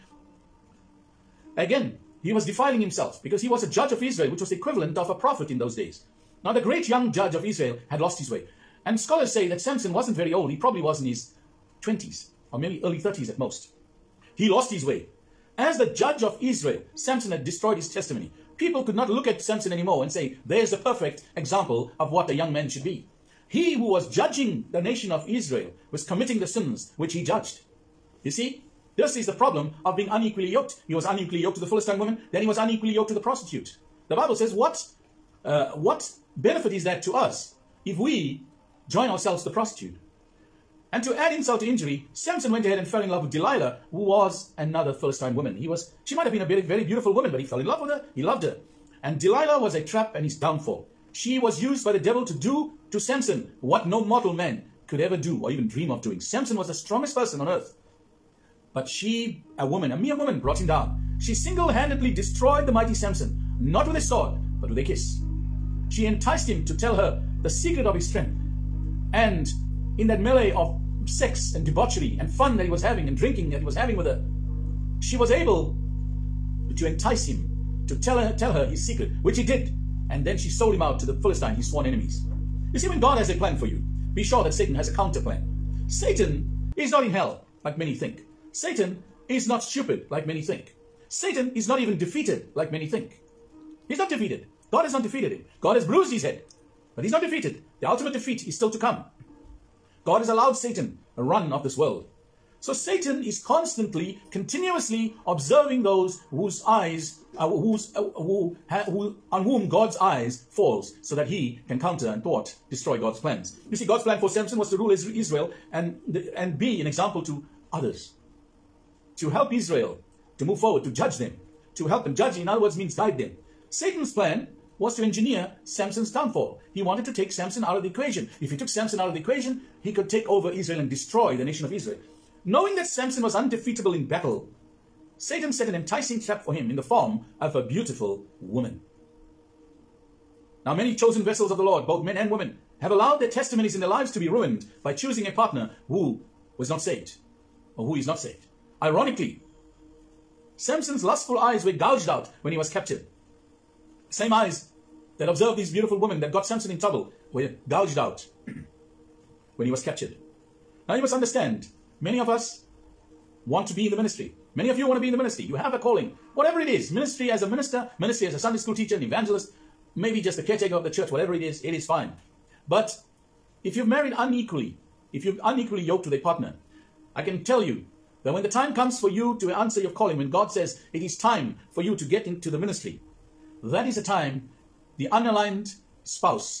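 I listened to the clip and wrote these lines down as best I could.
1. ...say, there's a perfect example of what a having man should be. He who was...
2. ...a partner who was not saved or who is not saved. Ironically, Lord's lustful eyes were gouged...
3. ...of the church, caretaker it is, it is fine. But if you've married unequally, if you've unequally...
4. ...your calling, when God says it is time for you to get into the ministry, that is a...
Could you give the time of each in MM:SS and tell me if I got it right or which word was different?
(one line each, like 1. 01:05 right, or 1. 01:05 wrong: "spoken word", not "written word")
1. 00:20 wrong: "young", not "having"
2. 02:25 wrong: "Samson", not "Lord"
3. 02:50 wrong: "whatever", not "caretaker"
4. 02:59 right.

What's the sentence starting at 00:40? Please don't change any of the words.
And to add insult to injury, Samson went ahead and fell in love with Delilah, who was another Philistine woman.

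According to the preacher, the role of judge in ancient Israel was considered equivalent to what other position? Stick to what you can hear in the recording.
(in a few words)
a prophet.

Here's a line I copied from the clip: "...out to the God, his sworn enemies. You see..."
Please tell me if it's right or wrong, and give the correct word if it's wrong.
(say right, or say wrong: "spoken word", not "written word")
wrong: "Philistine", not "God".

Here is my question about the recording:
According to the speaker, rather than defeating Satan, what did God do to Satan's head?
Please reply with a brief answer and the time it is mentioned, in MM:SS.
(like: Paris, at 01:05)
bruised, at 01:35.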